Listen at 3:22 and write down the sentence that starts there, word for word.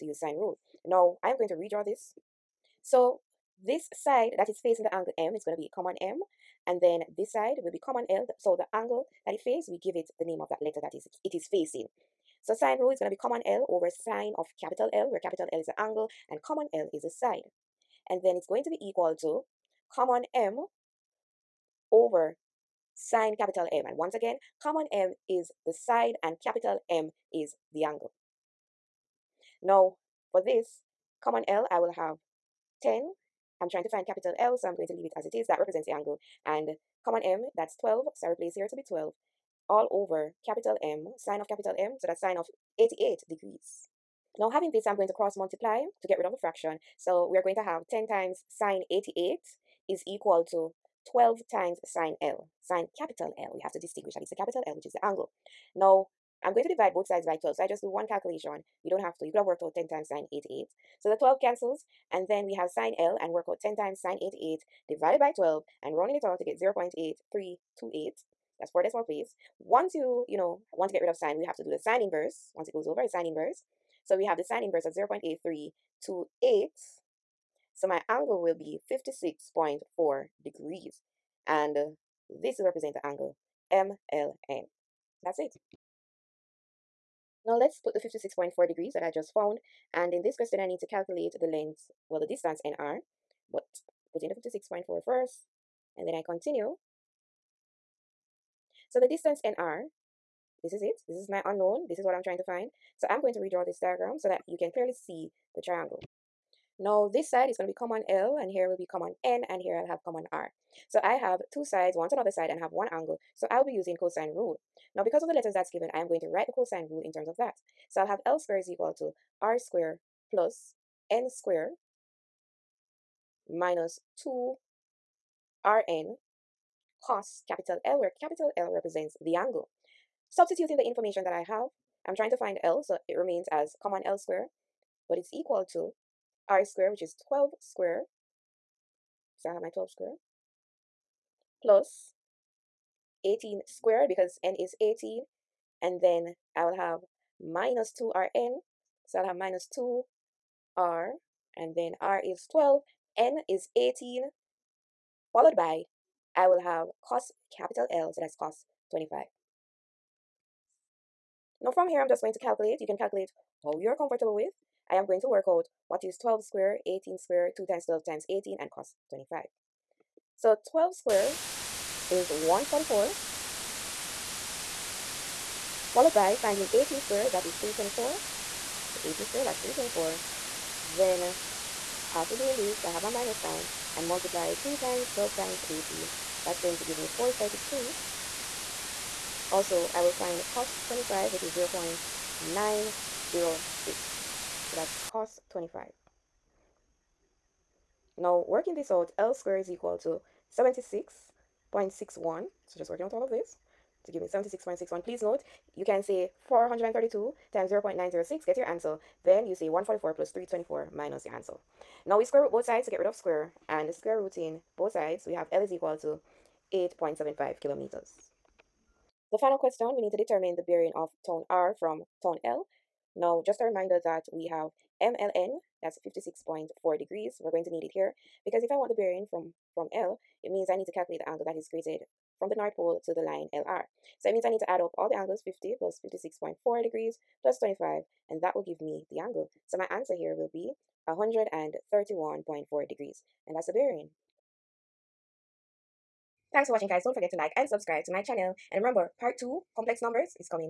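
So just working out all of this to give me 76.61.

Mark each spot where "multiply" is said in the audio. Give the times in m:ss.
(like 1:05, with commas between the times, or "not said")
0:45, 3:04.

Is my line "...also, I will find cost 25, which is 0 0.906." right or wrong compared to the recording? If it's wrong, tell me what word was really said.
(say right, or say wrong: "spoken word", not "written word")
right.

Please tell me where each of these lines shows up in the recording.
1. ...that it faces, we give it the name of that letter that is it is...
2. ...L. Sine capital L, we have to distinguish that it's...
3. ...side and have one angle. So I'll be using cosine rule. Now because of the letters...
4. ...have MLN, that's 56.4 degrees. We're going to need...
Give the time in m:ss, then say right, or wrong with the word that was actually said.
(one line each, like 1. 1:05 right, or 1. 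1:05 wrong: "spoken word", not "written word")
1. 0:09 right
2. 0:52 right
3. 1:52 right
4. 3:44 right.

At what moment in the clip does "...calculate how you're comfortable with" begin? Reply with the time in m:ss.
2:42.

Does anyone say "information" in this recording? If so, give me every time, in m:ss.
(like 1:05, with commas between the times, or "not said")
2:10.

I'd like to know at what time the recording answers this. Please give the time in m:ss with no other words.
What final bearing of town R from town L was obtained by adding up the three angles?
4:01.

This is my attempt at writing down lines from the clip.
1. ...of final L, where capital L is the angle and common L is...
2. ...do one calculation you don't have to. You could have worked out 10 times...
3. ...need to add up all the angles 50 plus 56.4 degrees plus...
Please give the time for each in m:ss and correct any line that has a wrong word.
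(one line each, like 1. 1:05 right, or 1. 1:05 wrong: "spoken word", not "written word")
1. 0:14 wrong: "capital", not "final"
2. 0:57 right
3. 3:54 right.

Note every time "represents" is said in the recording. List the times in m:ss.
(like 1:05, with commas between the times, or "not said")
0:35, 1:22, 2:08.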